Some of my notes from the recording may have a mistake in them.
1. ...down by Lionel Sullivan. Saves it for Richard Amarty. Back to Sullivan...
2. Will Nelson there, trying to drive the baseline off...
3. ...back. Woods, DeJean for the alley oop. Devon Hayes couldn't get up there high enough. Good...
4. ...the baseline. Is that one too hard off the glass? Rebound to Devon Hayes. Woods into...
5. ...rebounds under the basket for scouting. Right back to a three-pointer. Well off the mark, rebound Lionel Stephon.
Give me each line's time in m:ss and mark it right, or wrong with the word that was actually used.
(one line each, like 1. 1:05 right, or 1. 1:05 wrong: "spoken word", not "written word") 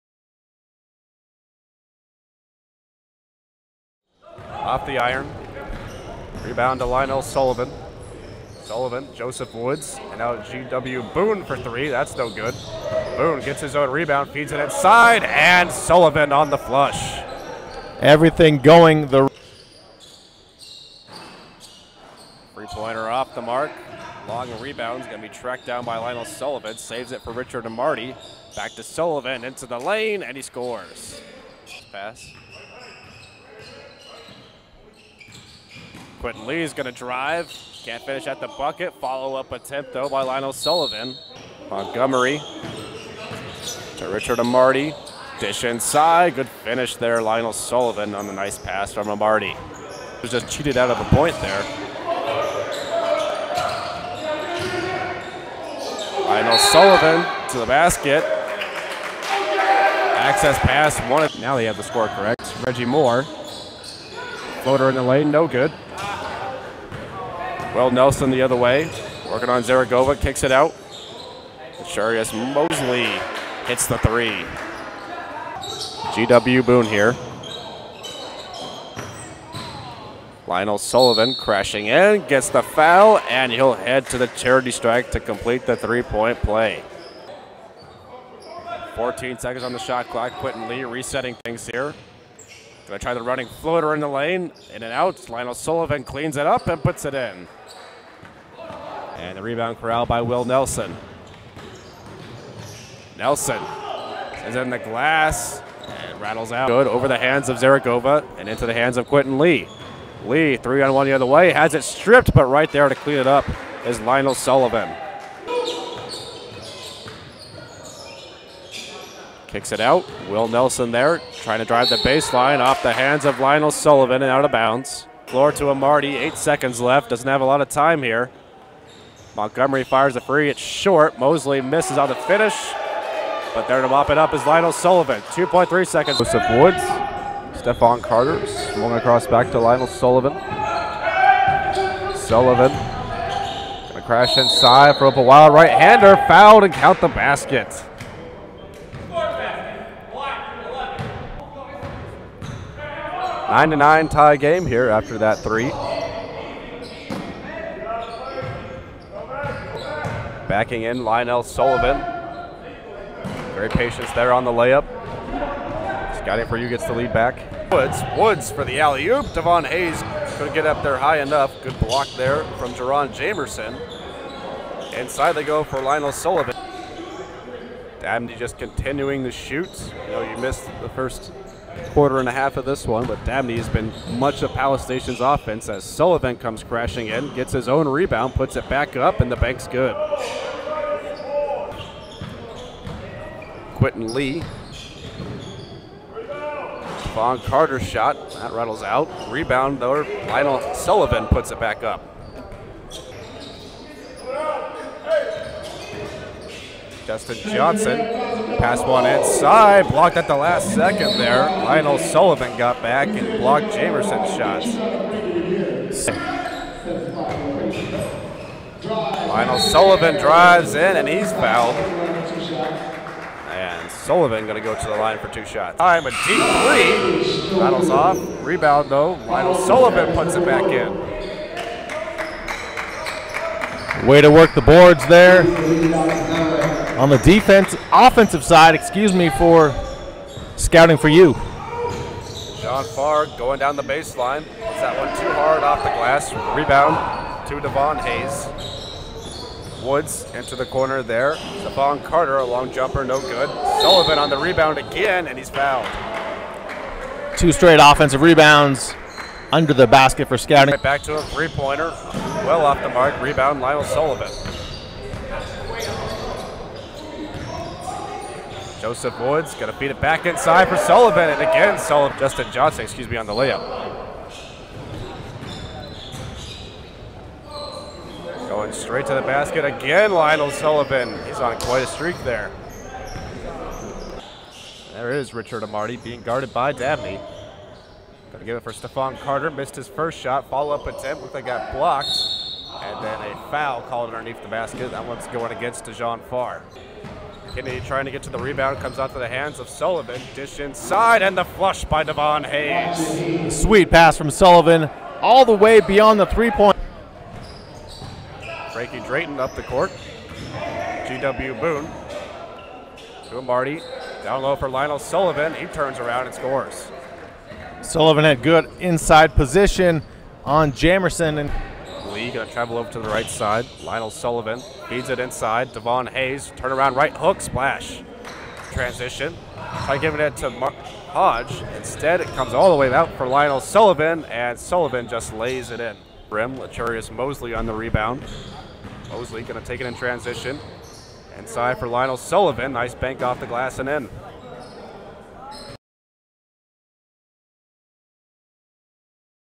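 1. 0:25 right
2. 2:00 right
3. 2:47 wrong: "Woods", not "DeJean"
4. 4:03 right
5. 4:18 wrong: "Sullivan", not "Stephon".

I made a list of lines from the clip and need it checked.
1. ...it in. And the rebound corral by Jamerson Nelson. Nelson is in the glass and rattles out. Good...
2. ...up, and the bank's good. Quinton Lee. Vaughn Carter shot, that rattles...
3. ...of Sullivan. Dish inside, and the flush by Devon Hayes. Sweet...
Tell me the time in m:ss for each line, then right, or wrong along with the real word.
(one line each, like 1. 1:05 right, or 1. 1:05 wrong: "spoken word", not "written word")
1. 1:37 wrong: "Will", not "Jamerson"
2. 3:08 right
3. 4:59 right.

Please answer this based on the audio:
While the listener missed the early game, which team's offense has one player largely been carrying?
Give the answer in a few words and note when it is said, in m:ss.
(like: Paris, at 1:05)
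Palace Station, at 3:04.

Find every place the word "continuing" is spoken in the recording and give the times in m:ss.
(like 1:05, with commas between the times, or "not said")
2:58.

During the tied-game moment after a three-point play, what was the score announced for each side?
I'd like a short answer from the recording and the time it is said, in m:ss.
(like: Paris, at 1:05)
9 to 9, at 2:33.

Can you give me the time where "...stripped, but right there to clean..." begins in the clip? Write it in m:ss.
1:51.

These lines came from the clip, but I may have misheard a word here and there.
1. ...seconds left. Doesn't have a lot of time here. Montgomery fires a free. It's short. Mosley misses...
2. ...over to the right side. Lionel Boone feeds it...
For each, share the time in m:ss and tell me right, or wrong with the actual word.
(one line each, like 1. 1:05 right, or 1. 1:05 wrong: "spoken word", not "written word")
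1. 2:06 right
2. 5:22 wrong: "Sullivan", not "Boone".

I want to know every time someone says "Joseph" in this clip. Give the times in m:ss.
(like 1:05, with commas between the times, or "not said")
0:09, 2:16, 4:28.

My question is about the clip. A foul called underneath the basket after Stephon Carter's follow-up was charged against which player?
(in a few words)
DeJean Farr.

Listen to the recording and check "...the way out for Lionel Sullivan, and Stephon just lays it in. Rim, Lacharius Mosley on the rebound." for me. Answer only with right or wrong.
wrong.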